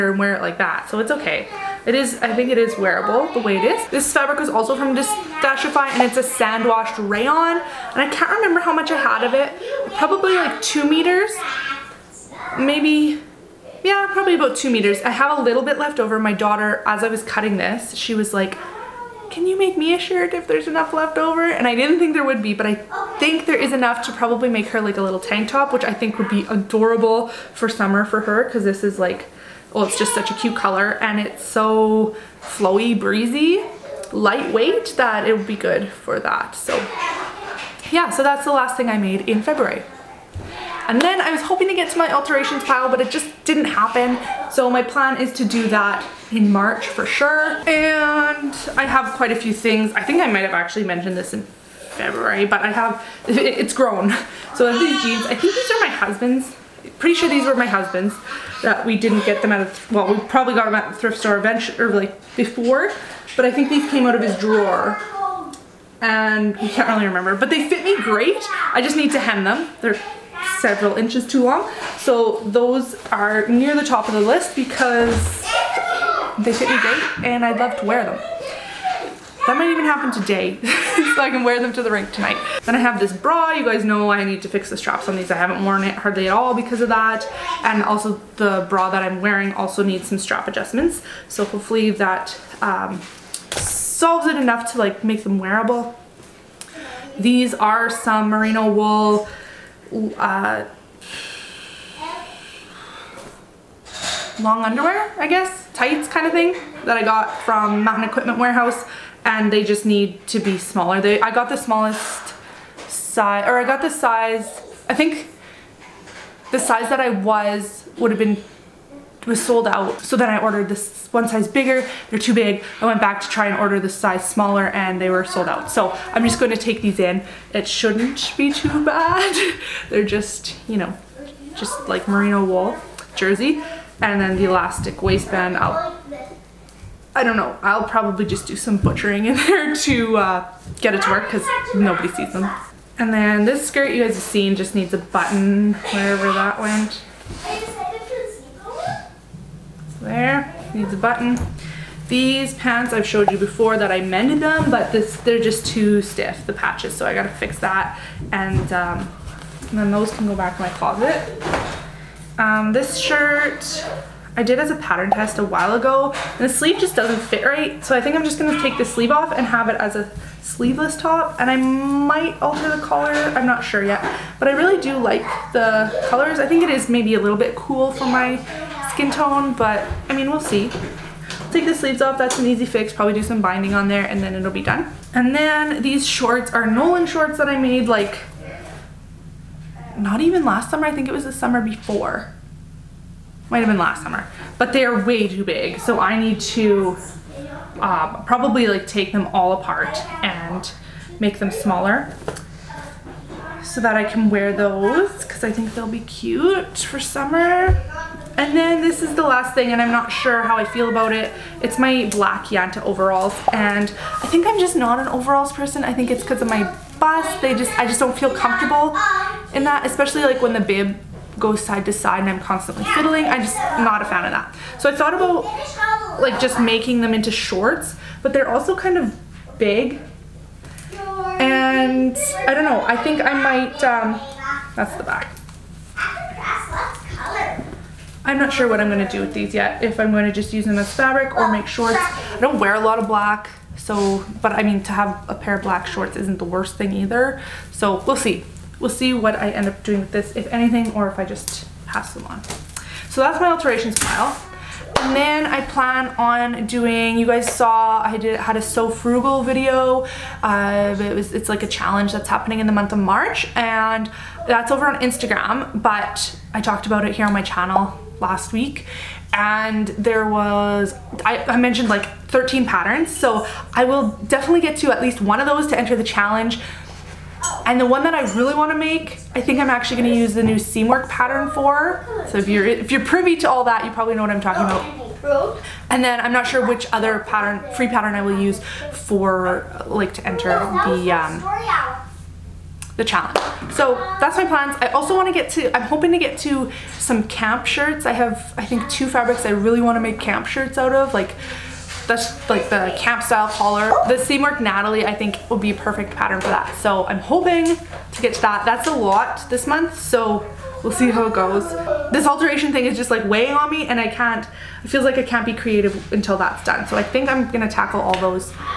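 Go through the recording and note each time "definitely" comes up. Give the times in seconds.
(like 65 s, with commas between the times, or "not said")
274 s.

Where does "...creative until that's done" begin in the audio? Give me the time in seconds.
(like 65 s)
315 s.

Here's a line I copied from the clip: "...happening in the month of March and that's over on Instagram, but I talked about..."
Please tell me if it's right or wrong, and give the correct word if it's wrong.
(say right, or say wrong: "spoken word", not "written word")
right.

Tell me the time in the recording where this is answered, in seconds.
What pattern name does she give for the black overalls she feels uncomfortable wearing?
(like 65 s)
212 s.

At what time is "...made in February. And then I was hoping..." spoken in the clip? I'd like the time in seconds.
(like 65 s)
38 s.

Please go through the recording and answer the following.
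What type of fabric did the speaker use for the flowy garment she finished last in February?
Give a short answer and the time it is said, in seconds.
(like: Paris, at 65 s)
sand washed rayon, at 6 s.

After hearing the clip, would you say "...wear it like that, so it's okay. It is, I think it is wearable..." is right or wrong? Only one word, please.
right.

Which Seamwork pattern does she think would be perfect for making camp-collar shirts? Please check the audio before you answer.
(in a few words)
Natalie.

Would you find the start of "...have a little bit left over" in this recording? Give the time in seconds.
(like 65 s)
15 s.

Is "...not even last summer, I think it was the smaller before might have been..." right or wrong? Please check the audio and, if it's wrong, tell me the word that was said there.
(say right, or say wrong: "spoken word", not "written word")
wrong: "summer", not "smaller".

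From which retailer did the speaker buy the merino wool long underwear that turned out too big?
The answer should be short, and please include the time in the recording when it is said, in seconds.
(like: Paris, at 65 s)
Mountain Equipment Warehouse, at 107 s.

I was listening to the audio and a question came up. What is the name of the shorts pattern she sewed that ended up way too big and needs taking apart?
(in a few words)
Nolan.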